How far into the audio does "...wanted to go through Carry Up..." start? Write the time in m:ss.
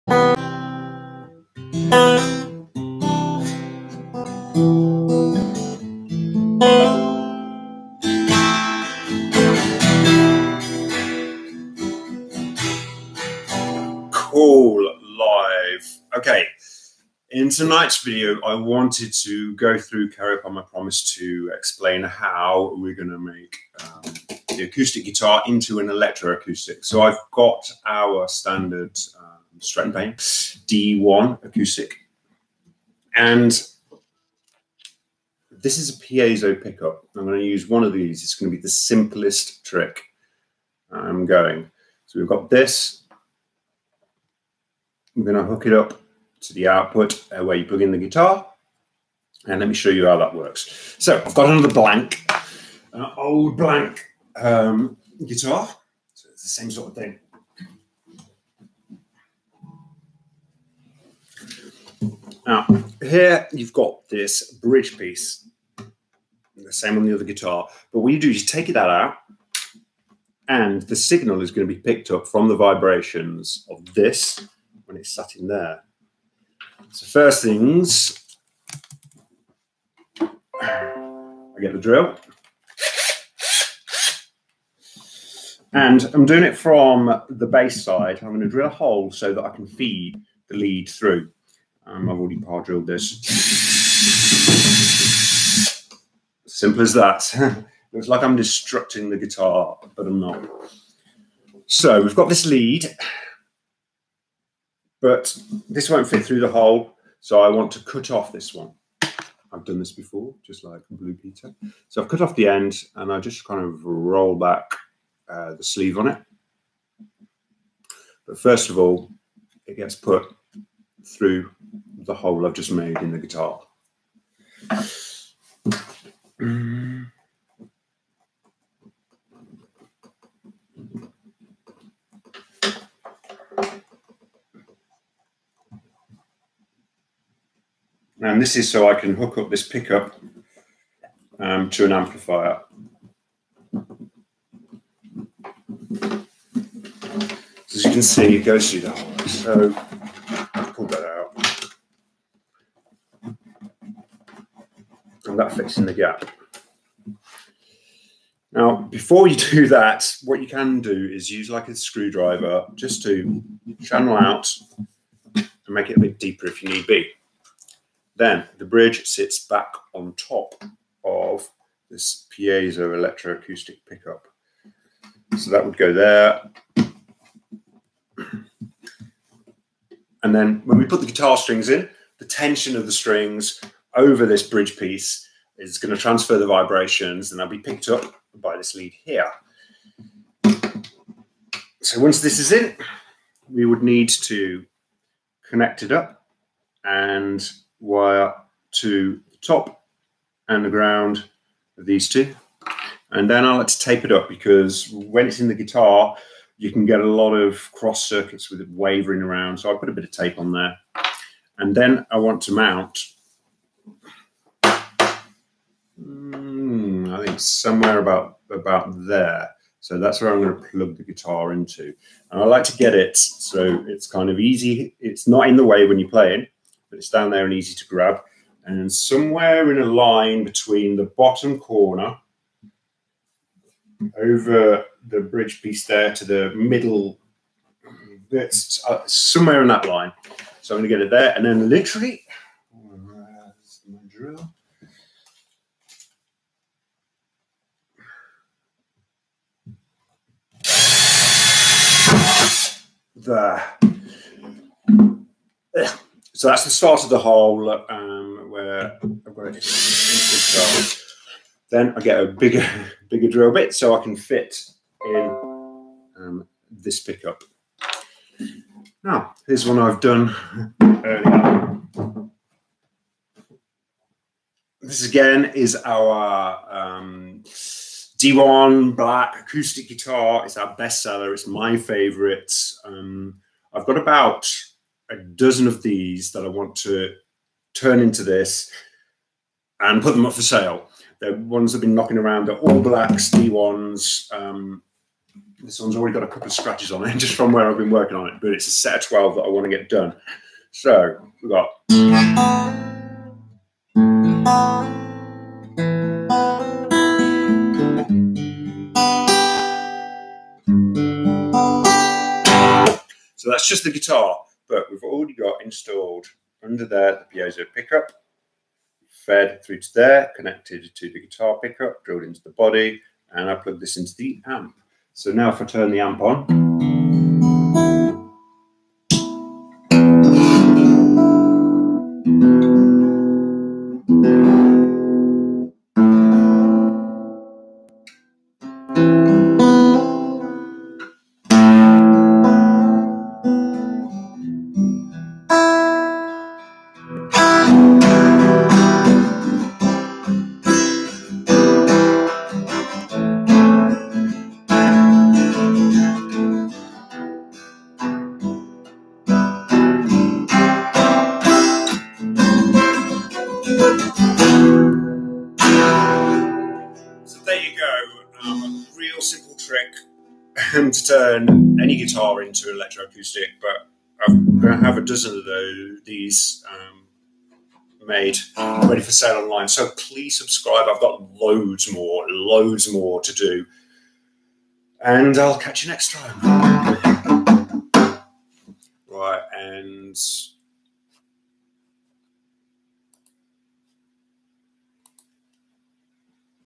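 0:18.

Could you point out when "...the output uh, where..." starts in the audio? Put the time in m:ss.
0:46.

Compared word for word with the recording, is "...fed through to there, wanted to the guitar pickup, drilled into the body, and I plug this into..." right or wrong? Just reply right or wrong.
wrong.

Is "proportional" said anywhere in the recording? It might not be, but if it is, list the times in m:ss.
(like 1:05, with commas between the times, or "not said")
not said.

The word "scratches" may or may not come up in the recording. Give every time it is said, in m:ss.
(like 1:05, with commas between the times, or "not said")
4:56.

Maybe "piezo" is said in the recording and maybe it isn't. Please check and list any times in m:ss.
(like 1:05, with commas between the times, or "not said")
0:36, 2:52, 5:17.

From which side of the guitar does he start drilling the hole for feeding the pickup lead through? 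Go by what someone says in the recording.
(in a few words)
Bass side.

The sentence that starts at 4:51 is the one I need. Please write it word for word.
The ones that have been knocking around are all blacks, D1s.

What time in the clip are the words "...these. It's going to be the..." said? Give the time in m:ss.
0:37.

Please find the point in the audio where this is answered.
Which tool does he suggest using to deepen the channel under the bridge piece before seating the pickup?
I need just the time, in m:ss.
2:41.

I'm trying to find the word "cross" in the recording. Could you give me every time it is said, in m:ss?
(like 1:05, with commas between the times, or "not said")
3:27.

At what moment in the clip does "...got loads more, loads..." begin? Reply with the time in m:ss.
6:21.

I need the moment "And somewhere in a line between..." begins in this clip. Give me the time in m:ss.
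3:48.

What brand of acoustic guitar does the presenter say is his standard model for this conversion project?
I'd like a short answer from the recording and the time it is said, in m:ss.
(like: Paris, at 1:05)
Stretton Payne, at 0:29.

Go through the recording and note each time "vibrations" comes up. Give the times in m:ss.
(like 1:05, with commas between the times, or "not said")
1:12, 3:06.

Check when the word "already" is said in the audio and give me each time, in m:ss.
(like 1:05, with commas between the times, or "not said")
1:32, 4:55, 5:15.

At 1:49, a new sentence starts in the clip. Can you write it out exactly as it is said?
I've done this before, just like Blue Peter.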